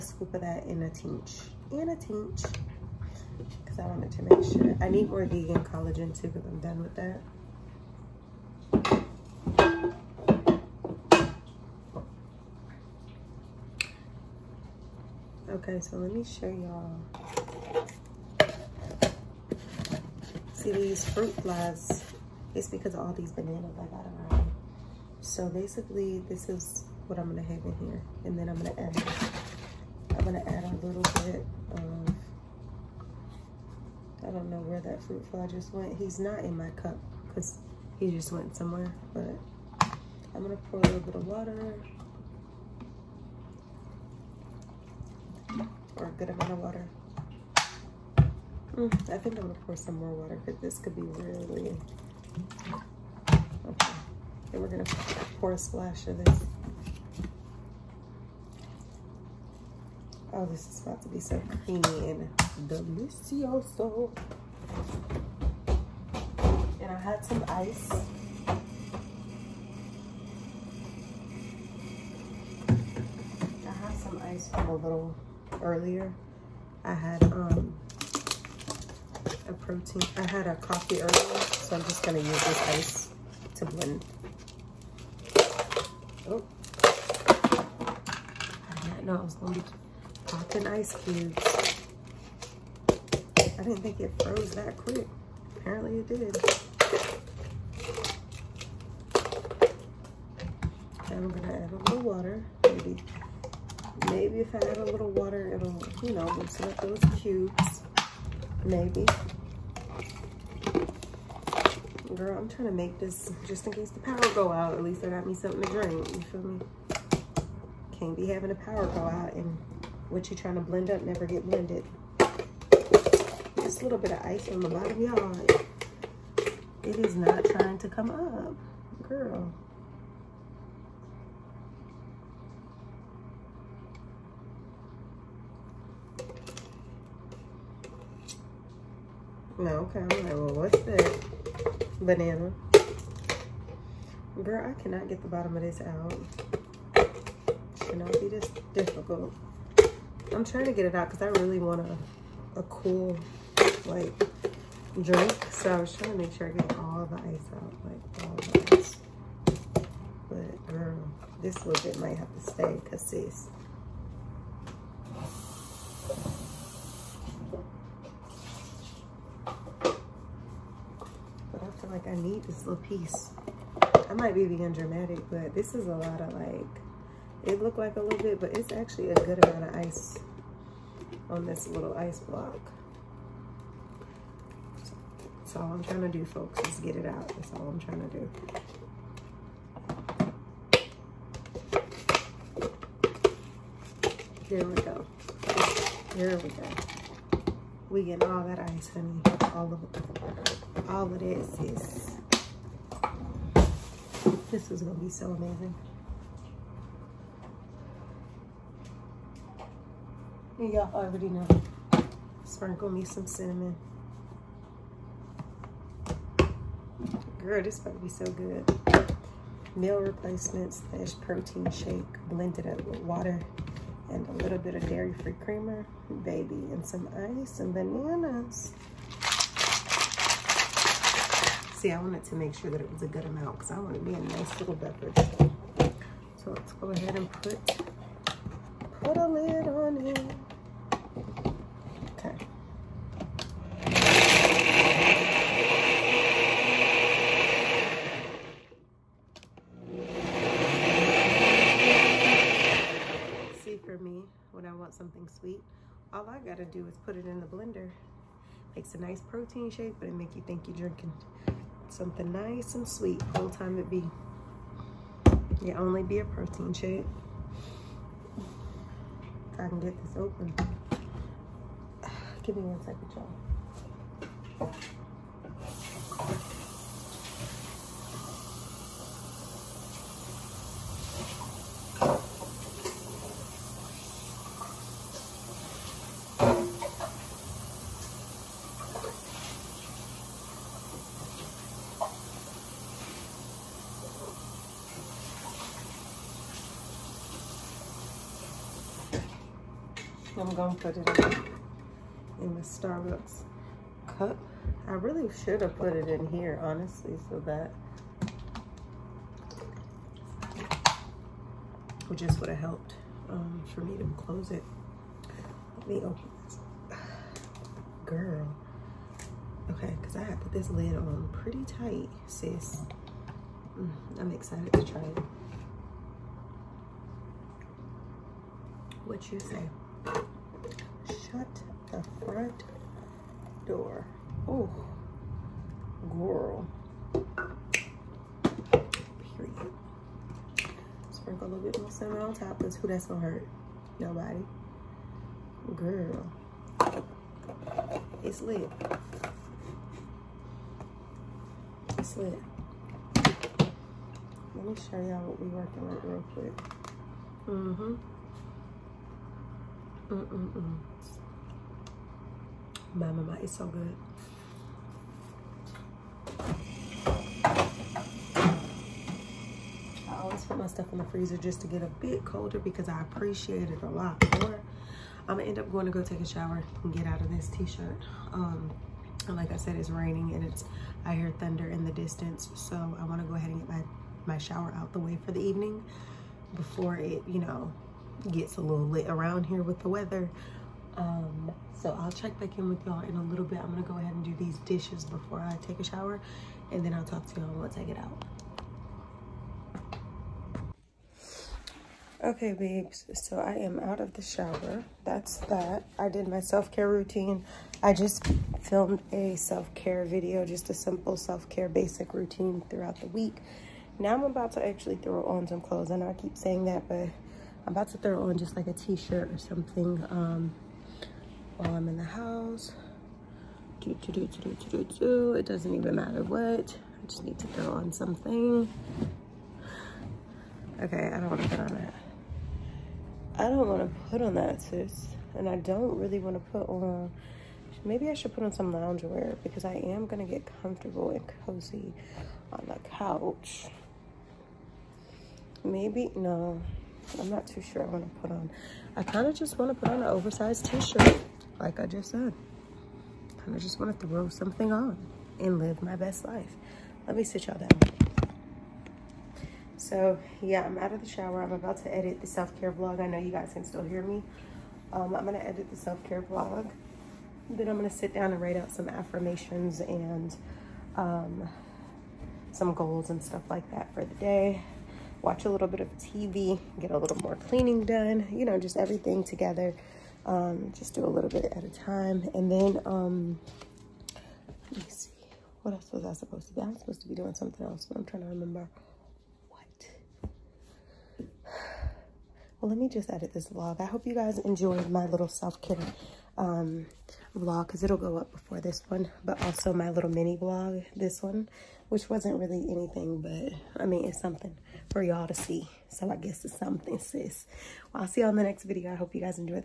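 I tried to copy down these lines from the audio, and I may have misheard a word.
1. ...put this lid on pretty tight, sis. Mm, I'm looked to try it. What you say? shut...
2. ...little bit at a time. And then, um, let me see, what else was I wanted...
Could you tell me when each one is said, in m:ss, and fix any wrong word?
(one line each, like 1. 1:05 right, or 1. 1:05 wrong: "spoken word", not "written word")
1. 5:20 wrong: "excited", not "looked"
2. 8:01 wrong: "supposed", not "wanted".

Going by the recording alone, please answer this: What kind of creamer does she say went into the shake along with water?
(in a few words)
dairy-free creamer.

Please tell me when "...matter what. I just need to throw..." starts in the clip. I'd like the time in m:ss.
7:05.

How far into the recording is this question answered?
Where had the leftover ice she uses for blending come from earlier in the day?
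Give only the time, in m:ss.
1:20.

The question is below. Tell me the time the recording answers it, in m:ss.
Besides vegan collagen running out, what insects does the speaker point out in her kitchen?
0:21.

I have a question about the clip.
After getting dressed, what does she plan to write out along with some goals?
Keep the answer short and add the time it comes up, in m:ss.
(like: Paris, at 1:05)
affirmations, at 7:48.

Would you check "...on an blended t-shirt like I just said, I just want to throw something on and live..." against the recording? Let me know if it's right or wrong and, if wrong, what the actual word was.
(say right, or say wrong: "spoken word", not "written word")
wrong: "oversized", not "blended".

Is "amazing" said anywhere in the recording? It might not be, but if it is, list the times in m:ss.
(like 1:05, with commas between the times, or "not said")
3:25.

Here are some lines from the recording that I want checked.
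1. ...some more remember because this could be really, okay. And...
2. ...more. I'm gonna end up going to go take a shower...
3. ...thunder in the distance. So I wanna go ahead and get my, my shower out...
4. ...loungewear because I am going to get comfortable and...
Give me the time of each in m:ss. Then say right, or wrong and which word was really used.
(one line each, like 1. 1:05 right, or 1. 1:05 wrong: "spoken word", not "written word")
1. 0:49 wrong: "water", not "remember"
2. 6:14 right
3. 6:21 right
4. 7:18 right.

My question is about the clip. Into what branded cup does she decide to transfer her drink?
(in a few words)
Starbucks cup.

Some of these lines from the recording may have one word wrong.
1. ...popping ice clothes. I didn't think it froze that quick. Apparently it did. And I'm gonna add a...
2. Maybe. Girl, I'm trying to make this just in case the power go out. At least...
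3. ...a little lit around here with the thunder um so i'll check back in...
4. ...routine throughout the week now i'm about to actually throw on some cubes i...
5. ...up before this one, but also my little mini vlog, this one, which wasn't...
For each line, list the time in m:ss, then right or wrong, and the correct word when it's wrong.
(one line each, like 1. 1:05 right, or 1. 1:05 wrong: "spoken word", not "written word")
1. 1:30 wrong: "cubes", not "clothes"
2. 1:48 right
3. 6:28 wrong: "weather", not "thunder"
4. 6:52 wrong: "clothes", not "cubes"
5. 8:18 right.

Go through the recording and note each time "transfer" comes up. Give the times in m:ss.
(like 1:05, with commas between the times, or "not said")
not said.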